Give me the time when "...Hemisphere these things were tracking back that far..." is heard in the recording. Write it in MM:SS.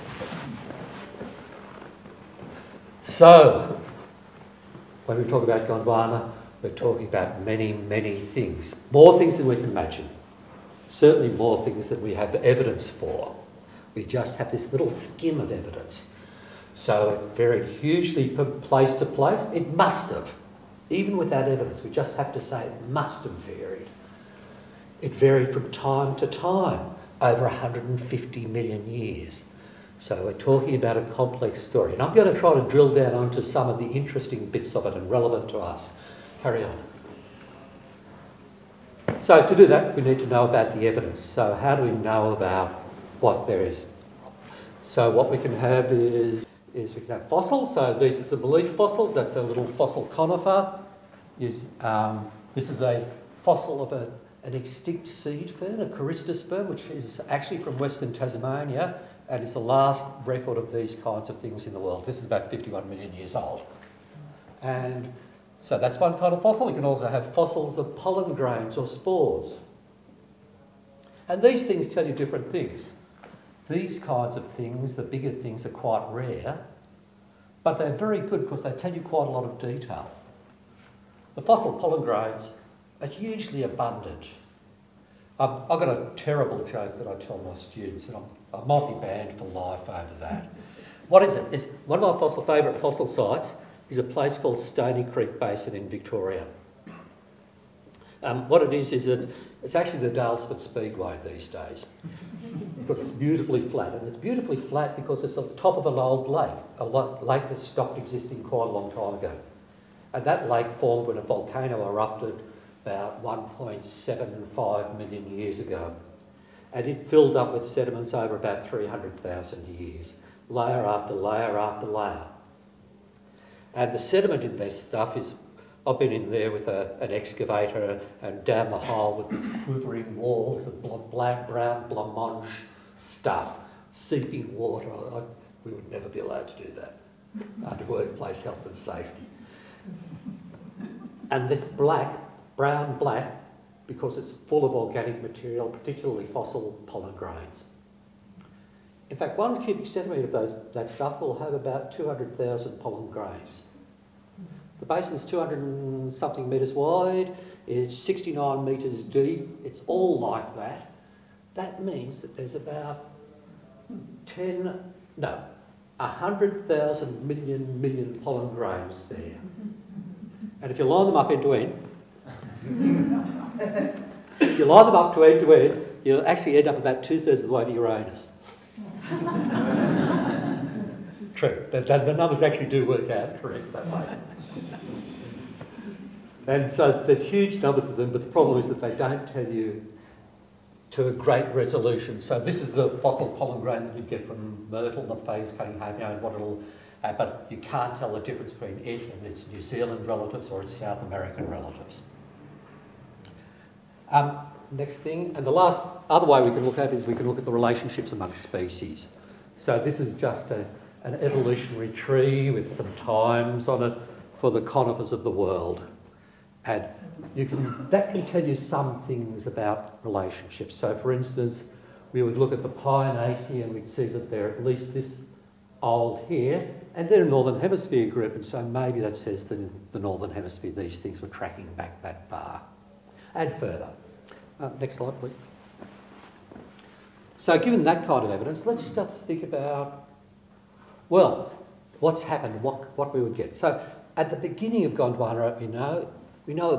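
03:50.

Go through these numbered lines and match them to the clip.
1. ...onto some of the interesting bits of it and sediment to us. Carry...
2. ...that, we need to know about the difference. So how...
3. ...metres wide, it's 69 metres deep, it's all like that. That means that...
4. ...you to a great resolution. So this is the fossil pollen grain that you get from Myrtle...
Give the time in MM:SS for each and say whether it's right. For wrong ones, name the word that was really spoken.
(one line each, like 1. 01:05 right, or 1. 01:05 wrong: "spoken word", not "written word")
1. 00:33 wrong: "relevant", not "sediment"
2. 00:39 wrong: "evidence", not "difference"
3. 02:36 right
4. 03:09 right.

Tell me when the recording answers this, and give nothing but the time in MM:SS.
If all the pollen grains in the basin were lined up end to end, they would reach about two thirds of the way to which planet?
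02:57.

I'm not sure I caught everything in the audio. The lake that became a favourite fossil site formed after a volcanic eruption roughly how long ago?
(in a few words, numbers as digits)
1.75 million years.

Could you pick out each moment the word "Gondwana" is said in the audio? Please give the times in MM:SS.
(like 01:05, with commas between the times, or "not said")
00:05, 04:04.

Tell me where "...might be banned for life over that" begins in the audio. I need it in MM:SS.
01:28.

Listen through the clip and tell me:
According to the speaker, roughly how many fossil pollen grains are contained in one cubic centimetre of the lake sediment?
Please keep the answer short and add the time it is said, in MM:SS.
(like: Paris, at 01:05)
200,000, at 02:31.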